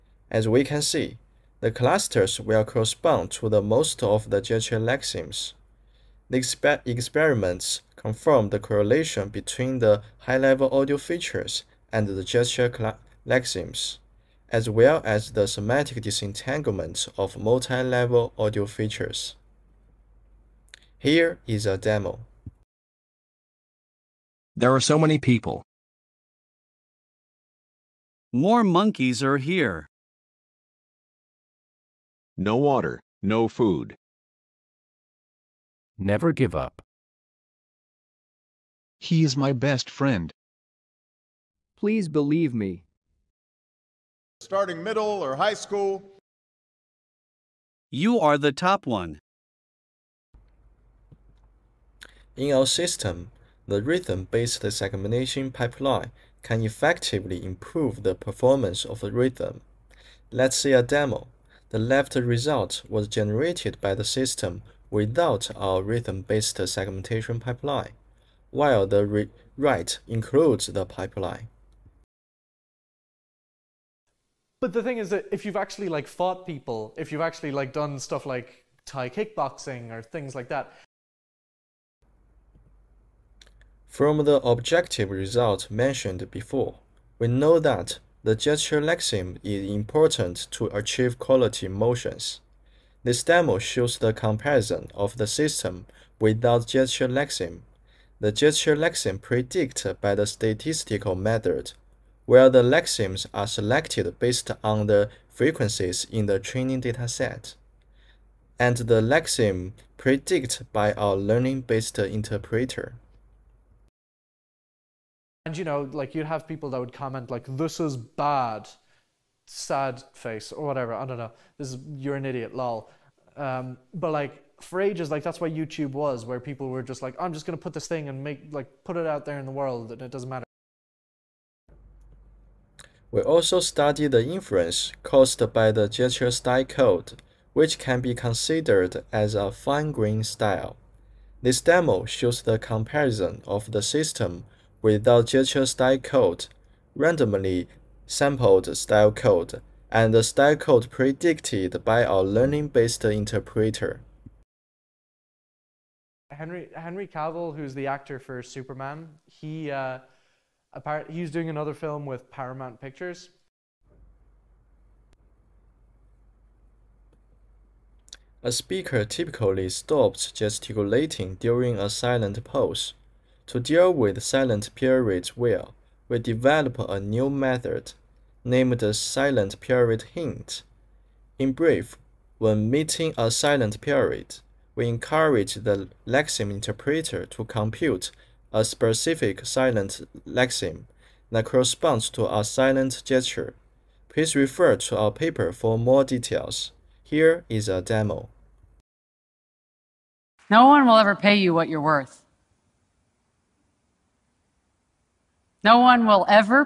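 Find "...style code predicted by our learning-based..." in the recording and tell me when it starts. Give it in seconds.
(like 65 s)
150 s.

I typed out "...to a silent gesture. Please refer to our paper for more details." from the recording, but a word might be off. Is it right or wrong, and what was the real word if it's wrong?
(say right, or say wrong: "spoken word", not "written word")
right.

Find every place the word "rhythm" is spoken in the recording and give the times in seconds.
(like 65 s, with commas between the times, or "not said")
53 s, 59 s, 65 s.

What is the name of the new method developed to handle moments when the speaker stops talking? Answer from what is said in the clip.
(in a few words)
silent period hint.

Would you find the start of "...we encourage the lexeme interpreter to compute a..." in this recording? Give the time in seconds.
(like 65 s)
184 s.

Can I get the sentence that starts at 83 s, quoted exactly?
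From the objective result mentioned before, we know that the gesture lexeme is important to achieve quality motions.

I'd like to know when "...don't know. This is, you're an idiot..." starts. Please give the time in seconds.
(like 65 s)
121 s.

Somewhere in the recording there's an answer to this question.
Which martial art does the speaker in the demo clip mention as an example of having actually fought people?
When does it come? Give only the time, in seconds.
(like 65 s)
78 s.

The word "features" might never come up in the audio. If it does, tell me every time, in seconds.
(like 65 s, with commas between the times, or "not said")
10 s, 18 s.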